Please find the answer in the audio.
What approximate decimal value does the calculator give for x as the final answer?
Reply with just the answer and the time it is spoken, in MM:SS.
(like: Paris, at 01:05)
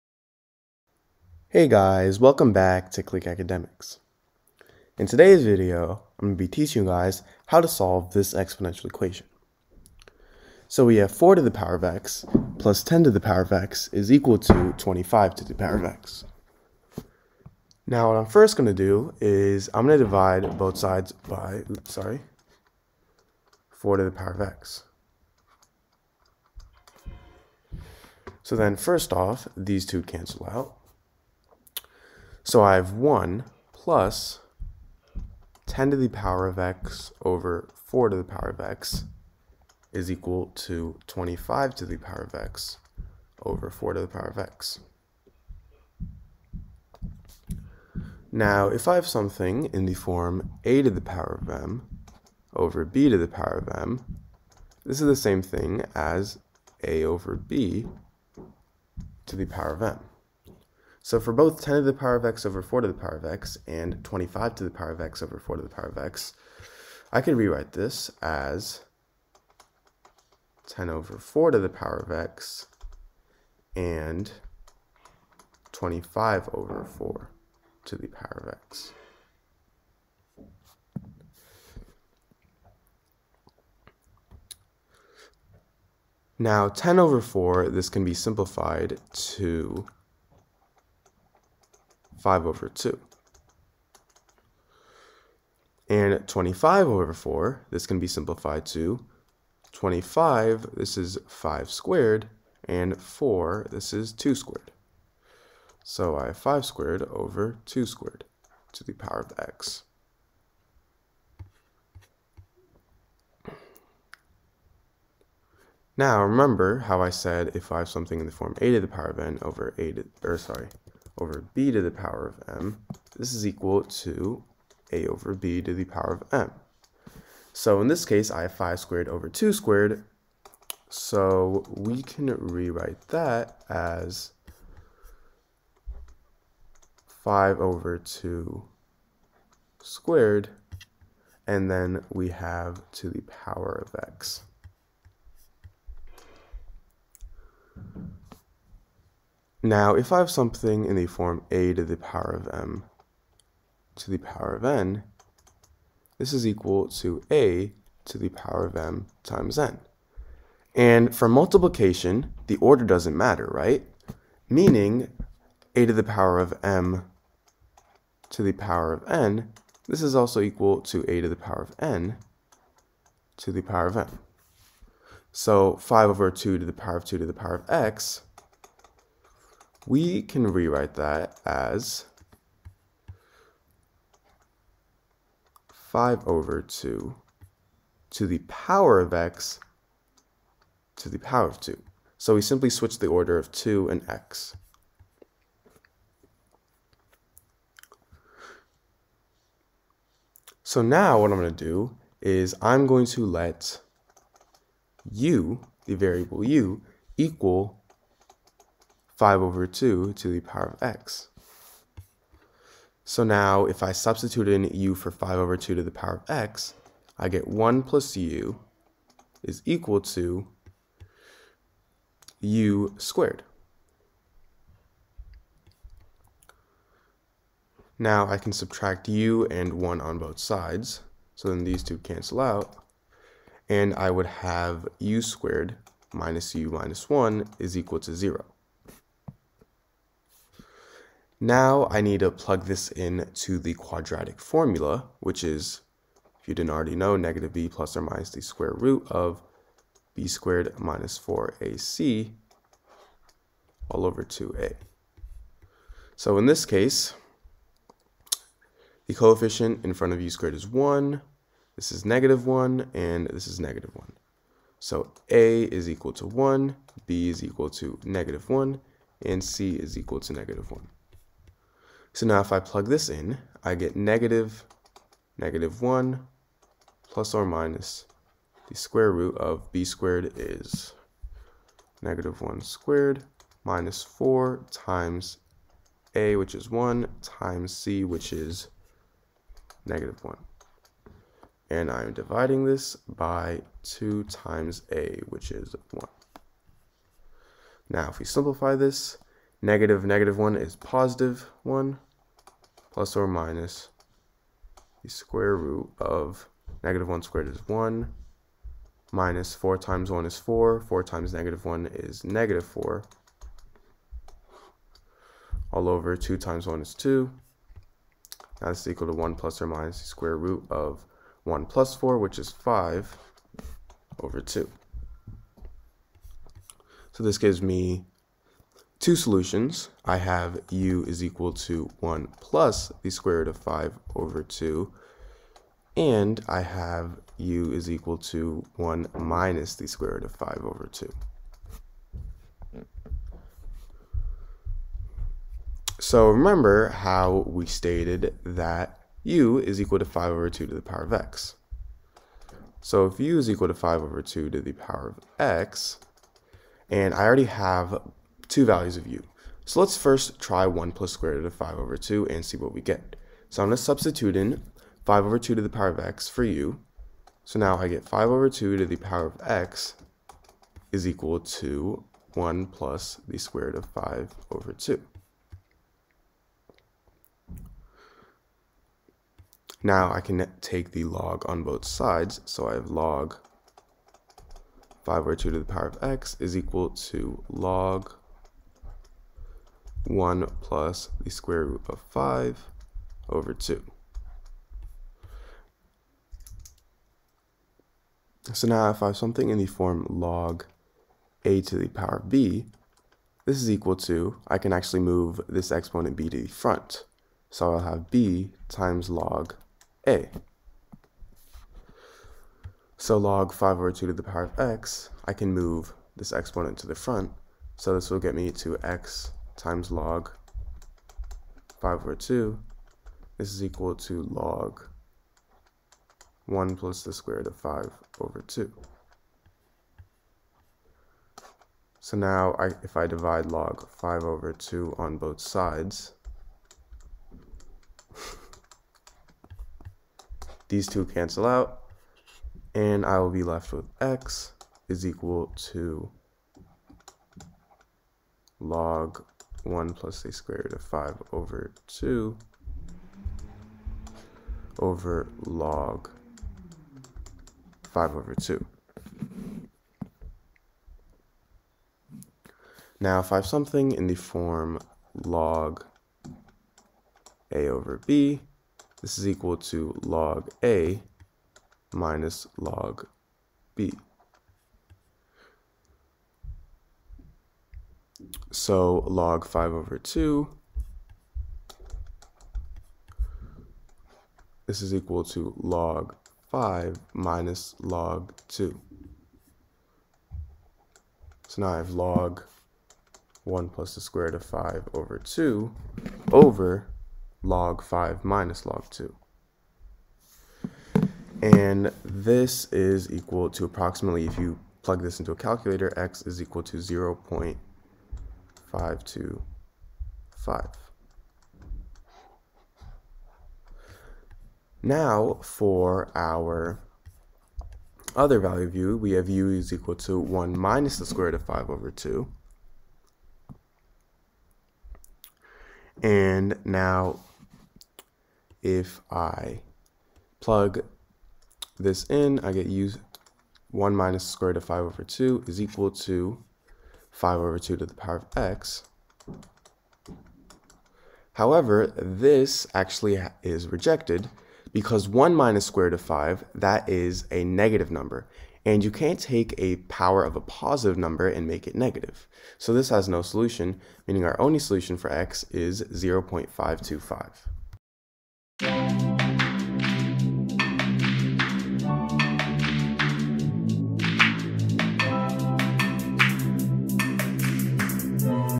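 0.525, at 09:15.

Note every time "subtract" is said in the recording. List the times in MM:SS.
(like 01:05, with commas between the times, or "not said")
03:48.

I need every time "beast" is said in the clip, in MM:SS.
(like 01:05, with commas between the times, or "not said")
not said.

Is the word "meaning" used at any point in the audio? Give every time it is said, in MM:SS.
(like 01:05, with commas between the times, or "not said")
02:44, 09:14.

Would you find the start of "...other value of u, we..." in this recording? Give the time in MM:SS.
08:38.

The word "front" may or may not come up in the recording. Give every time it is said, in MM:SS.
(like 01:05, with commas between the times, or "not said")
04:19, 06:46, 06:56.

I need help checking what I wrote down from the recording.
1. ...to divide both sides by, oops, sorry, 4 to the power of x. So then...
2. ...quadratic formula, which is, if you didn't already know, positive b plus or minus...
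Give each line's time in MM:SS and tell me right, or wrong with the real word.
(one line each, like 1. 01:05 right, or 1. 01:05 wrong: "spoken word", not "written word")
1. 00:19 right
2. 04:03 wrong: "negative", not "positive".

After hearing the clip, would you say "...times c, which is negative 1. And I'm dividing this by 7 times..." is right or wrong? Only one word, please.
wrong.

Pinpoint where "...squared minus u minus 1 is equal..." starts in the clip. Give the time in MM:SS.
03:55.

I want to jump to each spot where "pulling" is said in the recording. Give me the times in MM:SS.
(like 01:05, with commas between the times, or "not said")
not said.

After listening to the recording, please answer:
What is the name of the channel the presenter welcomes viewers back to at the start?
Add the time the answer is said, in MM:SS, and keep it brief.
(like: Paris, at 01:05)
Click Academics, at 00:03.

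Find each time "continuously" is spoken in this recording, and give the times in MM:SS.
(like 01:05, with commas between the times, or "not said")
not said.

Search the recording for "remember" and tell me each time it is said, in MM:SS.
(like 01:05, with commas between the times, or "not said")
01:56, 05:46.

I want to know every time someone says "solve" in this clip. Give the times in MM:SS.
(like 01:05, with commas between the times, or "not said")
00:07.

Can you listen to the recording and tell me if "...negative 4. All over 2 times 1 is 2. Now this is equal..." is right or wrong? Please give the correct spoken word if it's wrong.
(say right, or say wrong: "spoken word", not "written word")
right.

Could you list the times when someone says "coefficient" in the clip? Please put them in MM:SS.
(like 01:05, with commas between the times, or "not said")
04:19.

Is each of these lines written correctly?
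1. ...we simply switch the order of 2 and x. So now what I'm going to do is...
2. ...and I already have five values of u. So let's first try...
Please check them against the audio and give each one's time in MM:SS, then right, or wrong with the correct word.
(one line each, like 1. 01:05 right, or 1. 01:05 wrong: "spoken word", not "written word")
1. 03:12 right
2. 05:56 wrong: "two", not "five".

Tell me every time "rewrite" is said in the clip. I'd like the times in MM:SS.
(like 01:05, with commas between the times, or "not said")
01:07, 02:12, 03:00.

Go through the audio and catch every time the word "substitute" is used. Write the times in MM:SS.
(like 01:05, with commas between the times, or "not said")
03:33, 06:03.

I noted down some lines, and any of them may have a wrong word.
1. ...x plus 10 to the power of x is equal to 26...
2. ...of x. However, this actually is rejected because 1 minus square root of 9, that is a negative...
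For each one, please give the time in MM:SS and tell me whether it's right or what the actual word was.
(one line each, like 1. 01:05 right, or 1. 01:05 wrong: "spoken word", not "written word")
1. 00:11 wrong: "25", not "26"
2. 08:58 wrong: "5", not "9".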